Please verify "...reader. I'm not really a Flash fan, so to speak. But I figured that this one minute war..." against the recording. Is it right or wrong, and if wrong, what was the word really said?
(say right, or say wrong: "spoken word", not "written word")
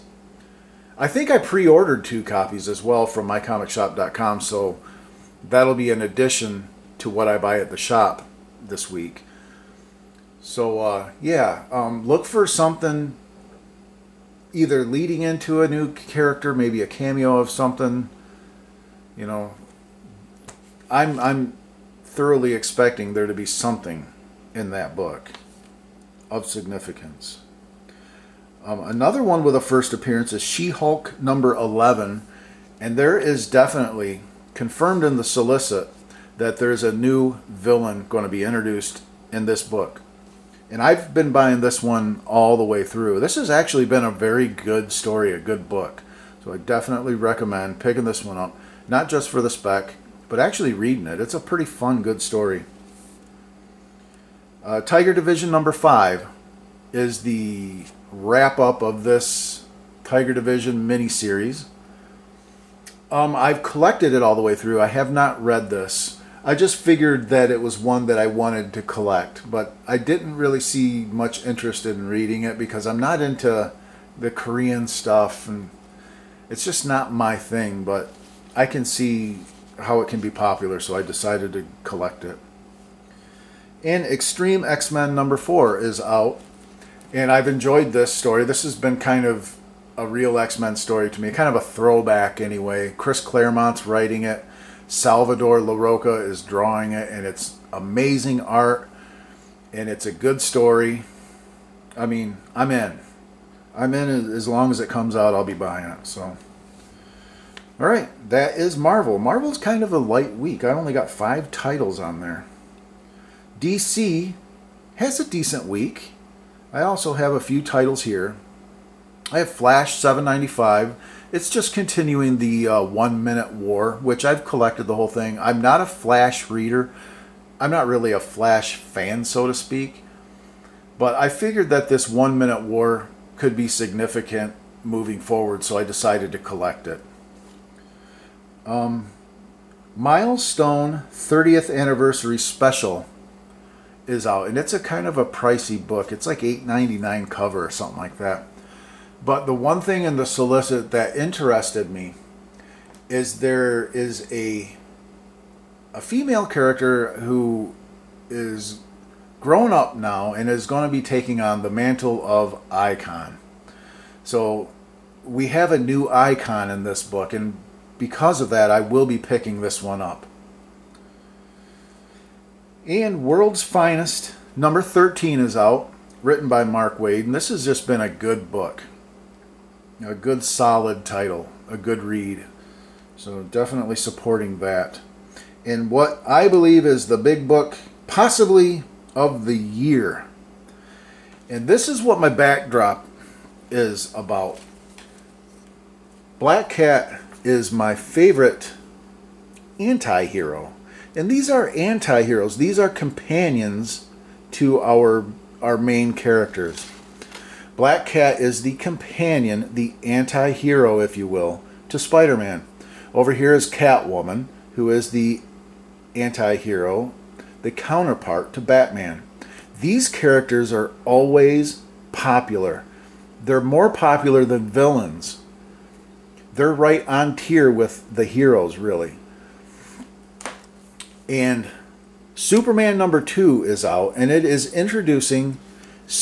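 right.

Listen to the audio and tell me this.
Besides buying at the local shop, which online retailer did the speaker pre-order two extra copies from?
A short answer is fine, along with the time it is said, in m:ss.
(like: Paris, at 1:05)
mycomicshop.com, at 0:03.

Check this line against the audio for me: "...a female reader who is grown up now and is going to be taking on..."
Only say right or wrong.
wrong.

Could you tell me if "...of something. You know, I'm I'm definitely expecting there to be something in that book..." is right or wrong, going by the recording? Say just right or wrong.
wrong.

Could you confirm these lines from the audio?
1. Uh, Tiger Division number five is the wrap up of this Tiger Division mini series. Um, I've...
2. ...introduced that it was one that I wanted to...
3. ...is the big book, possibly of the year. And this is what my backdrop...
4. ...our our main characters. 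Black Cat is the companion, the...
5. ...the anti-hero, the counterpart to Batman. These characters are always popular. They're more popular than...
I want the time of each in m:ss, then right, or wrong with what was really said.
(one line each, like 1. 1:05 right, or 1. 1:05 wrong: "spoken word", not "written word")
1. 0:54 right
2. 1:06 wrong: "figured", not "introduced"
3. 3:06 right
4. 3:24 right
5. 3:35 right.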